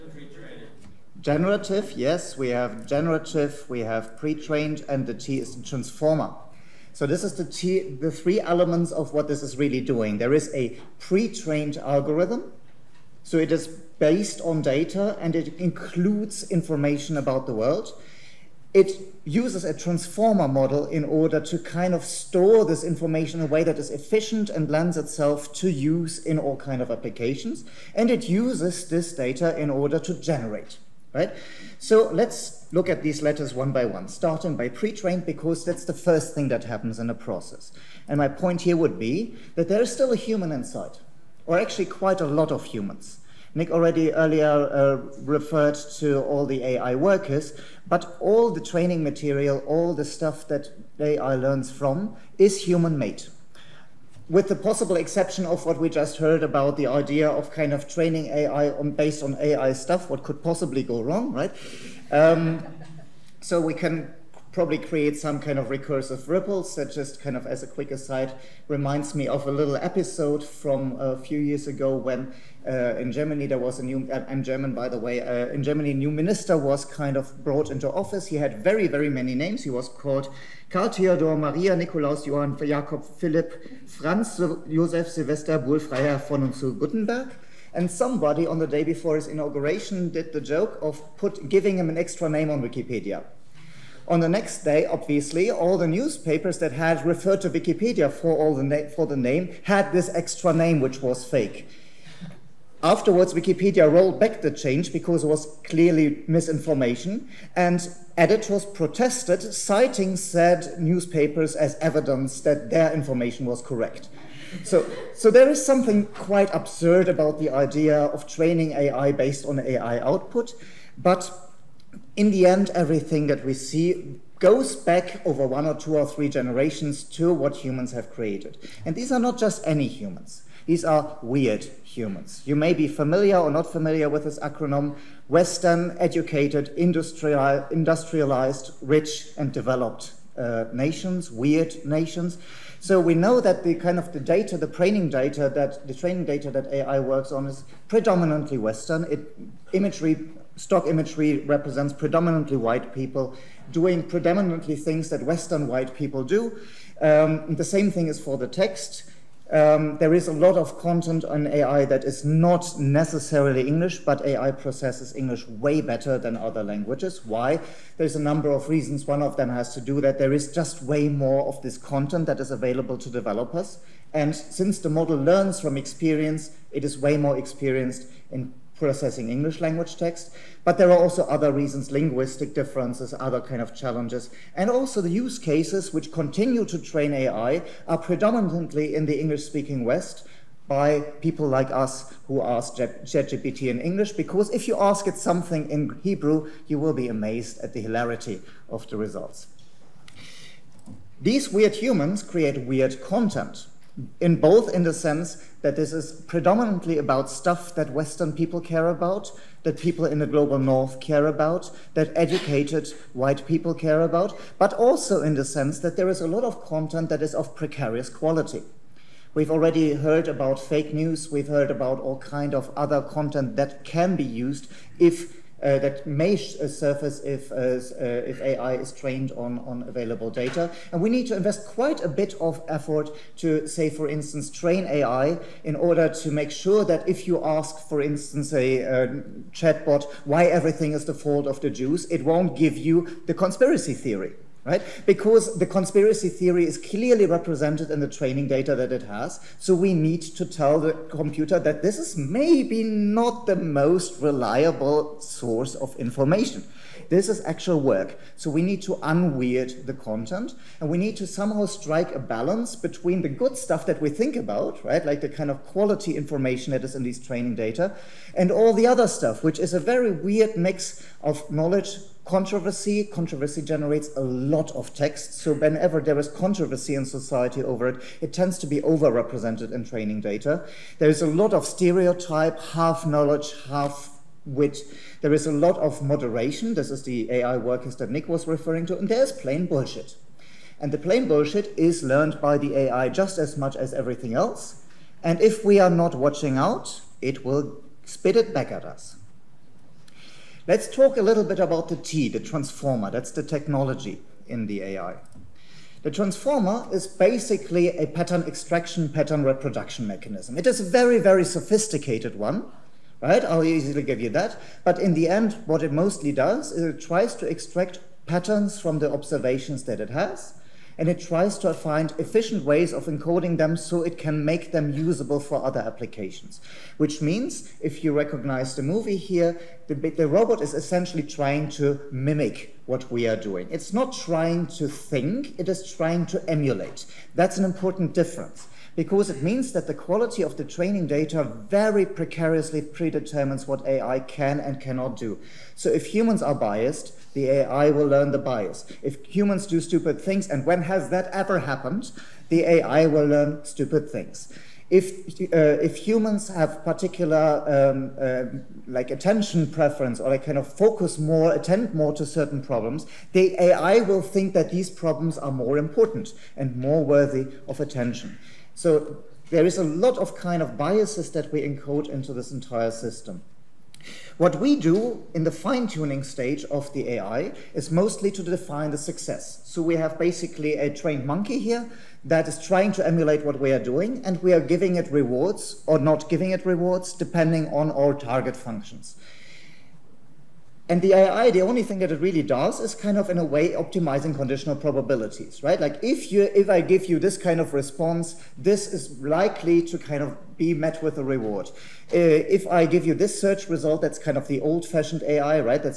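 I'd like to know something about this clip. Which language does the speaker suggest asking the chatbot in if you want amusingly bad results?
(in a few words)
Hebrew.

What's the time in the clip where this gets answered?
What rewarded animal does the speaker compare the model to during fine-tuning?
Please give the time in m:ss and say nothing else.
6:20.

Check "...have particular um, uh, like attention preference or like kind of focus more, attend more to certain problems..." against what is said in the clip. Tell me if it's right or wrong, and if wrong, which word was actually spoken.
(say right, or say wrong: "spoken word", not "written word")
right.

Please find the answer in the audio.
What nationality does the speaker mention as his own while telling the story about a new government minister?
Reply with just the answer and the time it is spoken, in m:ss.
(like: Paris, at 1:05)
German, at 1:14.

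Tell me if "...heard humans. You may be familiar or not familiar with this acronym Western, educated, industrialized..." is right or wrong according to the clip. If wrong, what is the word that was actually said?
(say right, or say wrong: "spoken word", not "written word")
wrong: "weird", not "heard".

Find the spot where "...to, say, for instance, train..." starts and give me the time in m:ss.
3:53.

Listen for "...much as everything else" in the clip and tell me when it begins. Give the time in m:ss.
4:53.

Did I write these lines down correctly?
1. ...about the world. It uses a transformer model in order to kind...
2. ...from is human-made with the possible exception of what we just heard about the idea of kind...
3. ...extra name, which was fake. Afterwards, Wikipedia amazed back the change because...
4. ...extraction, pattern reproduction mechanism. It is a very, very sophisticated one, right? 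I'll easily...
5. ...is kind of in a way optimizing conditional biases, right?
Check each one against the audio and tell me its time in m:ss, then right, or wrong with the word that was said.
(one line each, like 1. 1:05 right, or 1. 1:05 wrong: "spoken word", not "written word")
1. 0:17 right
2. 0:51 right
3. 1:40 wrong: "rolled", not "amazed"
4. 5:08 right
5. 6:32 wrong: "probabilities", not "biases".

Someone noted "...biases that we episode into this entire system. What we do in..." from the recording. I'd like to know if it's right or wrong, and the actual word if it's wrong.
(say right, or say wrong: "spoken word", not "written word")
wrong: "encode", not "episode".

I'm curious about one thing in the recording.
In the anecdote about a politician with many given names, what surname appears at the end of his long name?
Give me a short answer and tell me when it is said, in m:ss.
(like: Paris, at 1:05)
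Guttenberg, at 1:26.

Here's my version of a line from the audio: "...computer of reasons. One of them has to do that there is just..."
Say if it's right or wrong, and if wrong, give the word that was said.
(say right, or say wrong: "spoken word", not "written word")
wrong: "number", not "computer".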